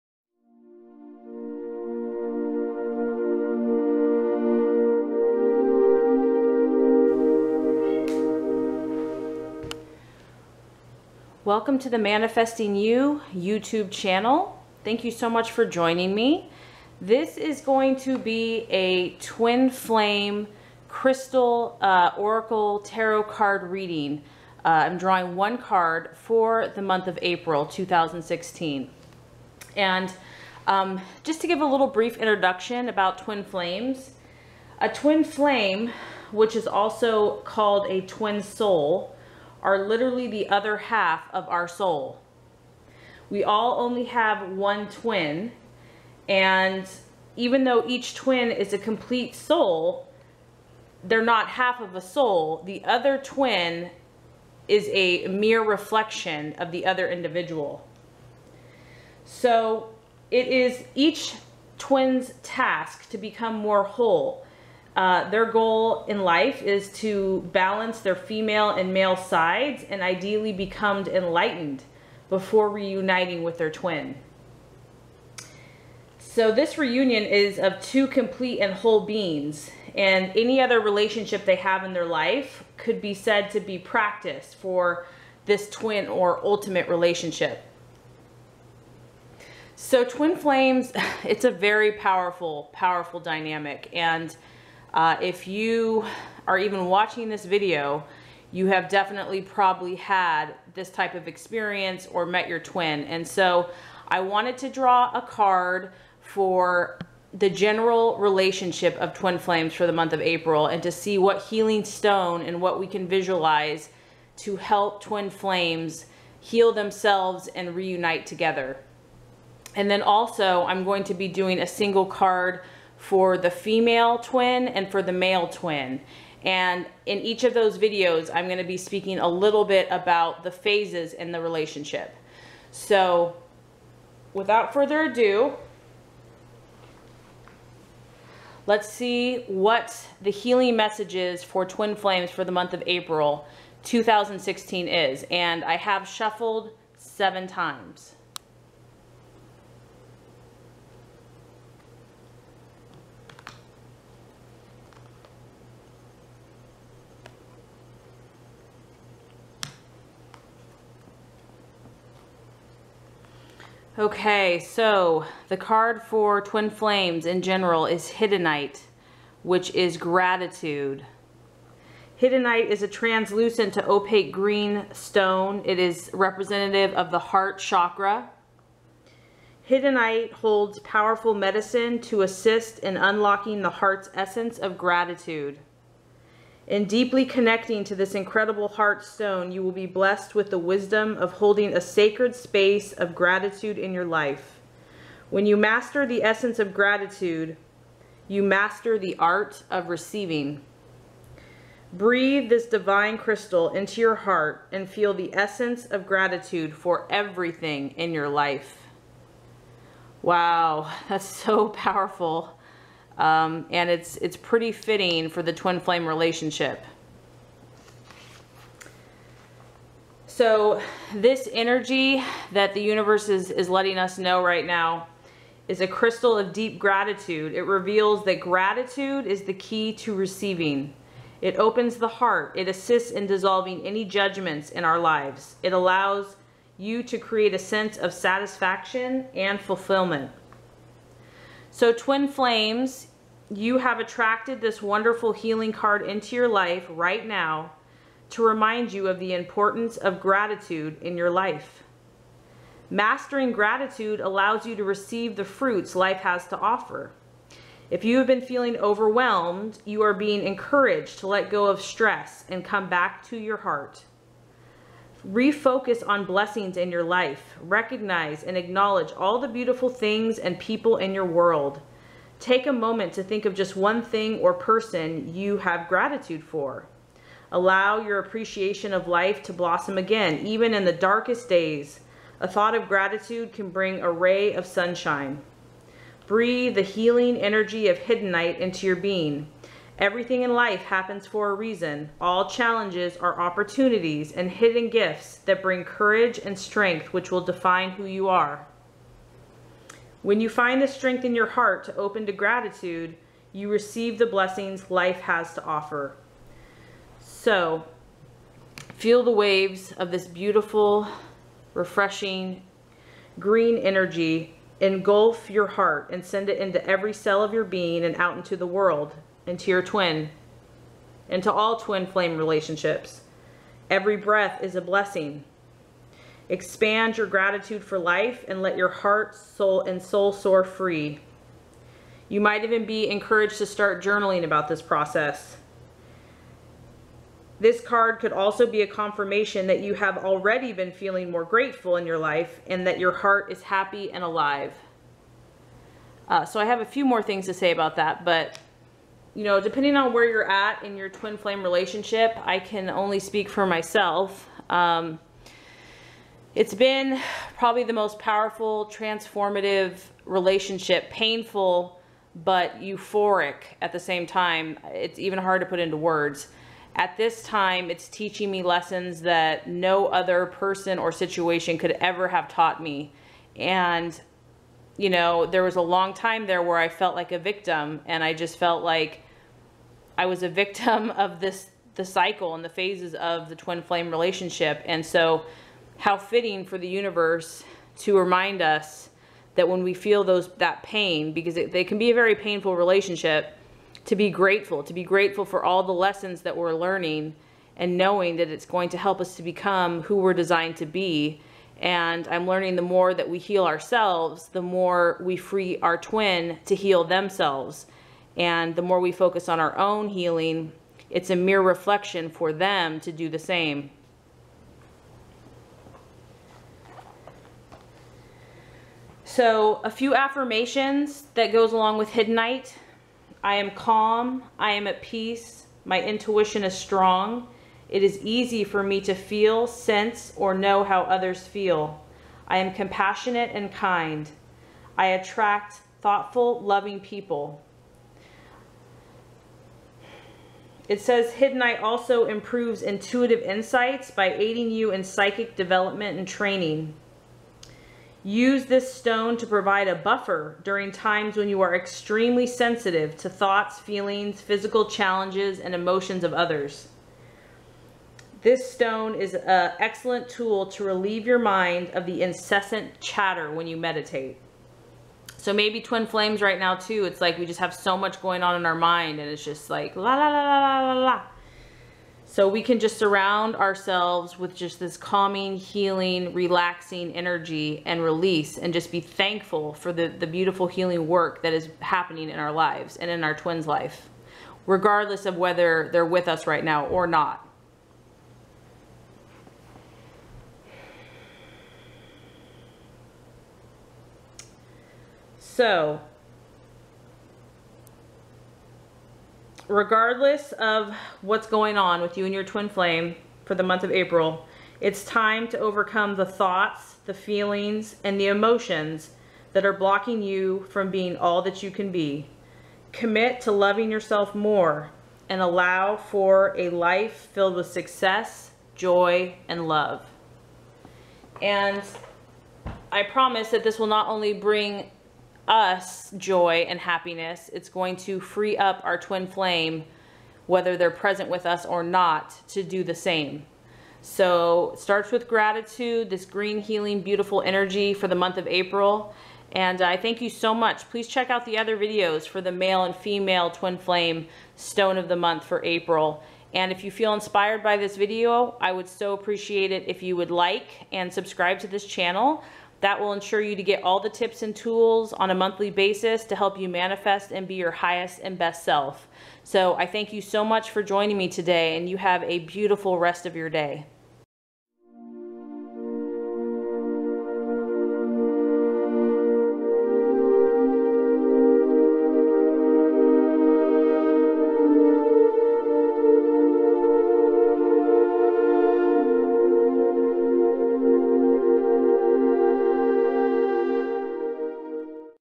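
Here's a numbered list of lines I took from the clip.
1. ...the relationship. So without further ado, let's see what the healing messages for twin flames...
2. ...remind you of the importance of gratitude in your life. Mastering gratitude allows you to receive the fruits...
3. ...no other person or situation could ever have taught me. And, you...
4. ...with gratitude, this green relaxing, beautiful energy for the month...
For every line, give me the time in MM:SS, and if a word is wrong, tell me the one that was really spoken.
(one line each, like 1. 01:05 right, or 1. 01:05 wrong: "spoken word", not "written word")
1. 02:11 right
2. 04:08 right
3. 06:09 right
4. 08:55 wrong: "healing", not "relaxing".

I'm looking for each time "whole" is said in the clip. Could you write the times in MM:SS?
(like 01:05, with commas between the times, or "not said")
01:03, 01:18.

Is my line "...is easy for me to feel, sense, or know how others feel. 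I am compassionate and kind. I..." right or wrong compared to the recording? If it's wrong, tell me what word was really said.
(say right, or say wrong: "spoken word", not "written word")
right.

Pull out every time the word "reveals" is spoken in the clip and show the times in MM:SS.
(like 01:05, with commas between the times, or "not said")
03:47.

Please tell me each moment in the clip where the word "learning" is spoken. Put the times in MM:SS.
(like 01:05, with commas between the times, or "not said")
06:36, 06:42.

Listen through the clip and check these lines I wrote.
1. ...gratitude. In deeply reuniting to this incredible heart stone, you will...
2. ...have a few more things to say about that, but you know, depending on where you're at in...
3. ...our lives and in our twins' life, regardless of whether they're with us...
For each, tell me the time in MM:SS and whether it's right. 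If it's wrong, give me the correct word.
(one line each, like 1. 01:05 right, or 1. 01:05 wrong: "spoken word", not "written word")
1. 03:04 wrong: "connecting", not "reuniting"
2. 05:46 right
3. 08:02 right.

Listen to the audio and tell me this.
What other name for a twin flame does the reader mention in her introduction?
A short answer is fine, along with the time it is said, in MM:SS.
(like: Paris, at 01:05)
twin soul, at 00:38.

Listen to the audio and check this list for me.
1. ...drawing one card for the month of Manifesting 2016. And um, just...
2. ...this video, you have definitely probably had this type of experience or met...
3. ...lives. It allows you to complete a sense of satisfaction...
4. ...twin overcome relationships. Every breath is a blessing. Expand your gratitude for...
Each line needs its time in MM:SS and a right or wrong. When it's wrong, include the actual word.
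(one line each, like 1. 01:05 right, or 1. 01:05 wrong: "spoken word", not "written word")
1. 00:24 wrong: "April", not "Manifesting"
2. 01:37 right
3. 03:54 wrong: "create", not "complete"
4. 05:21 wrong: "flame", not "overcome".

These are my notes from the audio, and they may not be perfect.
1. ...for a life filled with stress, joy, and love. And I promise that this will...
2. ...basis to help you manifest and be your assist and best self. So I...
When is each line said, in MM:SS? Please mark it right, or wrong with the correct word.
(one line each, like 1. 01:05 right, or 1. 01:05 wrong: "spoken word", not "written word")
1. 08:35 wrong: "success", not "stress"
2. 09:15 wrong: "highest", not "assist".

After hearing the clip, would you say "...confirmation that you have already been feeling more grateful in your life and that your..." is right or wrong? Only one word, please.
right.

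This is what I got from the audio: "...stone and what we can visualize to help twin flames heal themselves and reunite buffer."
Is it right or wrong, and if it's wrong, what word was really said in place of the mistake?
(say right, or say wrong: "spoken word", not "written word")
wrong: "together", not "buffer".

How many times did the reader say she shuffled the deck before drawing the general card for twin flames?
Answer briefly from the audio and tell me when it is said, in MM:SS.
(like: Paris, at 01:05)
7, at 02:26.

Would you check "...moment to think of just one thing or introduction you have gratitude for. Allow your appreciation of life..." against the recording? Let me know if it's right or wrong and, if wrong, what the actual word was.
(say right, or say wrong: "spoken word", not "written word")
wrong: "person", not "introduction".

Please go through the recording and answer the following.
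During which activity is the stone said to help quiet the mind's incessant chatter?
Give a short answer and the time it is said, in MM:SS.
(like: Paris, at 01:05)
meditate, at 07:43.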